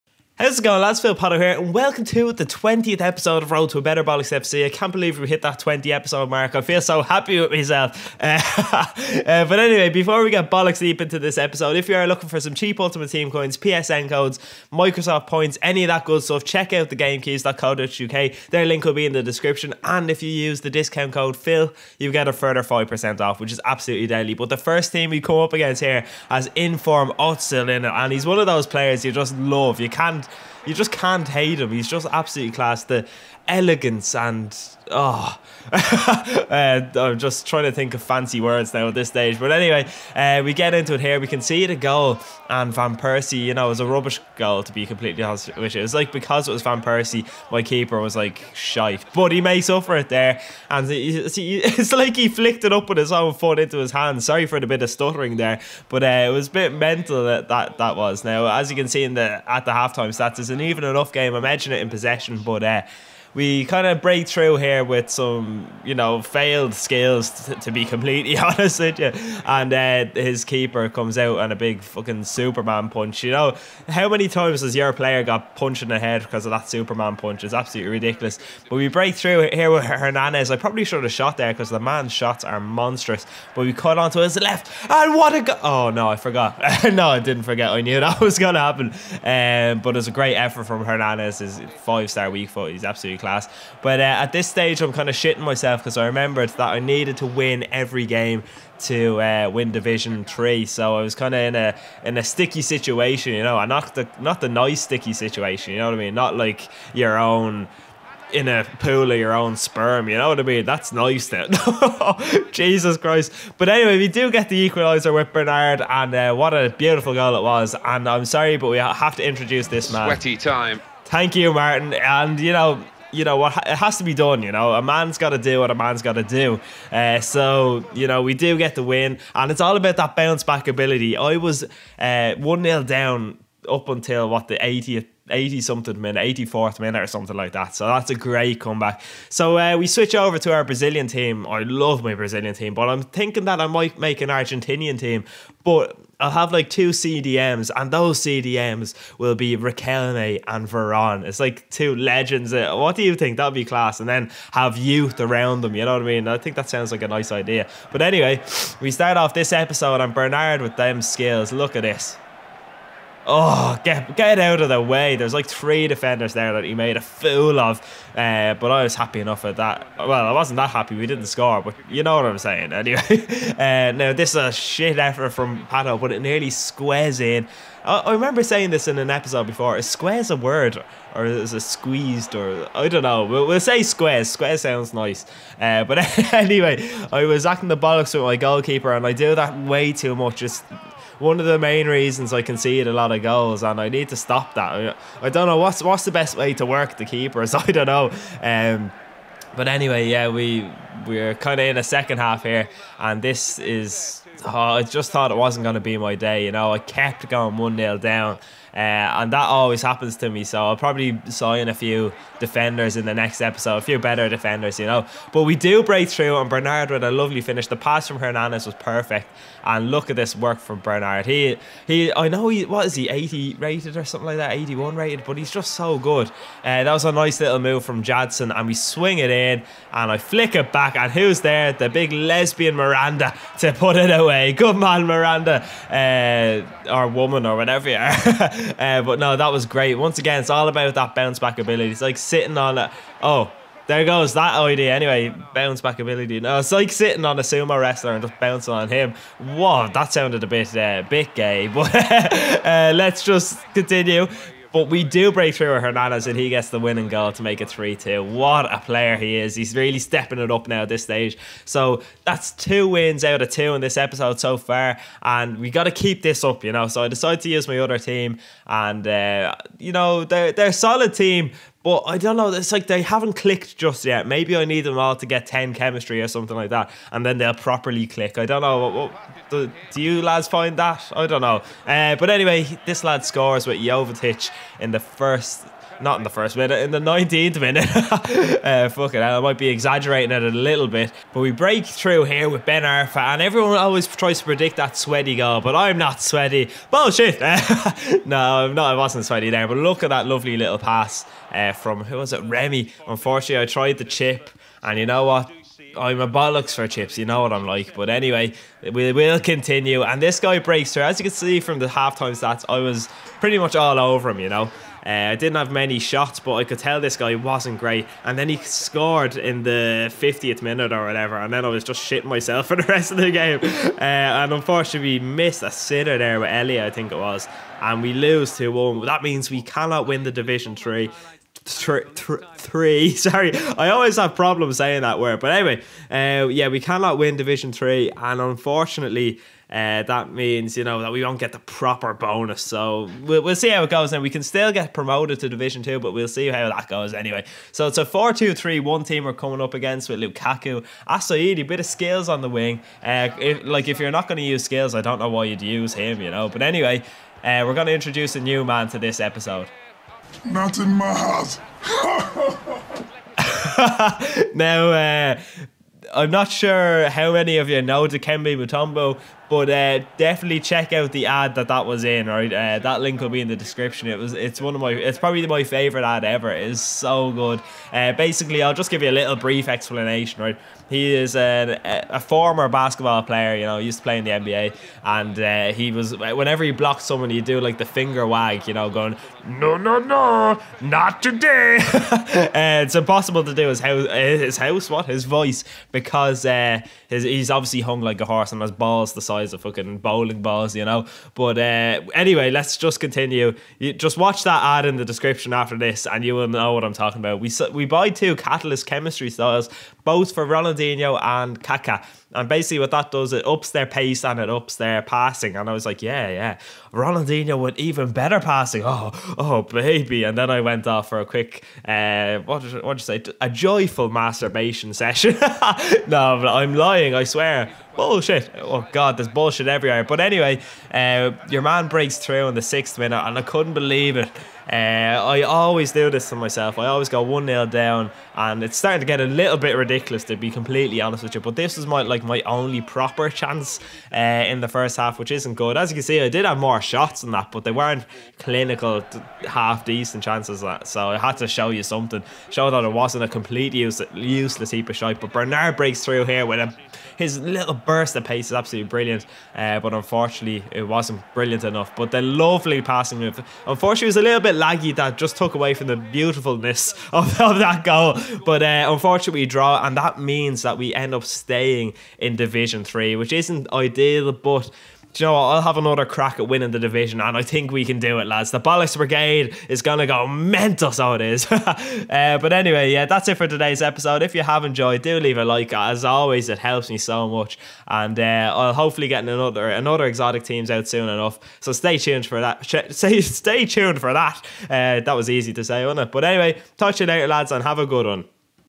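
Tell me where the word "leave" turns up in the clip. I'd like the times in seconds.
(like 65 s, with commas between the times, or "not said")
485 s.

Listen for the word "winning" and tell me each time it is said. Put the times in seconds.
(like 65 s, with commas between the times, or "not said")
256 s, 476 s.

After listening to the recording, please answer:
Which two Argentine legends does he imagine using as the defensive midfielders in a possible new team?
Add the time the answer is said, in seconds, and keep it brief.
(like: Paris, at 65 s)
Riquelme and Veron, at 149 s.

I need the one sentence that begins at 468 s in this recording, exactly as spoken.
But uh, unfortunately, draw, and that means that we end up staying in Division 3, which isn't ideal, but you know what?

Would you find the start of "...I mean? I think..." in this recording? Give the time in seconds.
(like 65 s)
156 s.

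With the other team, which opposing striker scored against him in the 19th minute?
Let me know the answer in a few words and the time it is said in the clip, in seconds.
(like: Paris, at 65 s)
Jovetic, at 283 s.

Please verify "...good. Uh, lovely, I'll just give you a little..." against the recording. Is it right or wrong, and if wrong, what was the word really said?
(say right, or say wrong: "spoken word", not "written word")
wrong: "basically", not "lovely".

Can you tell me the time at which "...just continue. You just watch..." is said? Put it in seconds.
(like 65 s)
402 s.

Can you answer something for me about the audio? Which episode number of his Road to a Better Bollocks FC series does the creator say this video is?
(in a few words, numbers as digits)
20.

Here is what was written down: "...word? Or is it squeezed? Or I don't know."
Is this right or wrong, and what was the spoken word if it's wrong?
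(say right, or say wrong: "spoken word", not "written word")
right.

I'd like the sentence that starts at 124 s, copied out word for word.
You know, a man's got to do what a man's got to do.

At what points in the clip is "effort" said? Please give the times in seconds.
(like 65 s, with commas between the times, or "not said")
90 s, 174 s.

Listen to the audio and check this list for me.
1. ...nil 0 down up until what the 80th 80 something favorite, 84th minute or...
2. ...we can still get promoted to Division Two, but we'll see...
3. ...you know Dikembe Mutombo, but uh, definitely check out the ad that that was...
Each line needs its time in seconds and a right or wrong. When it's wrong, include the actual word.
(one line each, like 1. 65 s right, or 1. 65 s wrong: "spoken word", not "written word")
1. 132 s wrong: "minute", not "favorite"
2. 344 s right
3. 367 s right.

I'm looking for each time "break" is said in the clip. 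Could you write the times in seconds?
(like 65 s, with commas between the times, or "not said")
64 s, 78 s, 215 s, 255 s, 291 s, 310 s, 431 s, 455 s.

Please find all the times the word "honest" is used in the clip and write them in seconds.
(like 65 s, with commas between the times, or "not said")
45 s, 68 s, 441 s.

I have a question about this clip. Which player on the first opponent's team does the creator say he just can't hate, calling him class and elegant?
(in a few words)
Özil.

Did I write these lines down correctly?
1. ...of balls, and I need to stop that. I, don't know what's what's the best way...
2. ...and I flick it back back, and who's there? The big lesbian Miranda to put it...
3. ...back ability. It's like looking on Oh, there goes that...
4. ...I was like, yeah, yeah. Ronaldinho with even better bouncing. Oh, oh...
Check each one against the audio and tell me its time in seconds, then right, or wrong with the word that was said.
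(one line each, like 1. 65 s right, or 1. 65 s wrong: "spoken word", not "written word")
1. 193 s wrong: "goals", not "balls"
2. 229 s right
3. 241 s wrong: "sitting", not "looking"
4. 415 s wrong: "passing", not "bouncing".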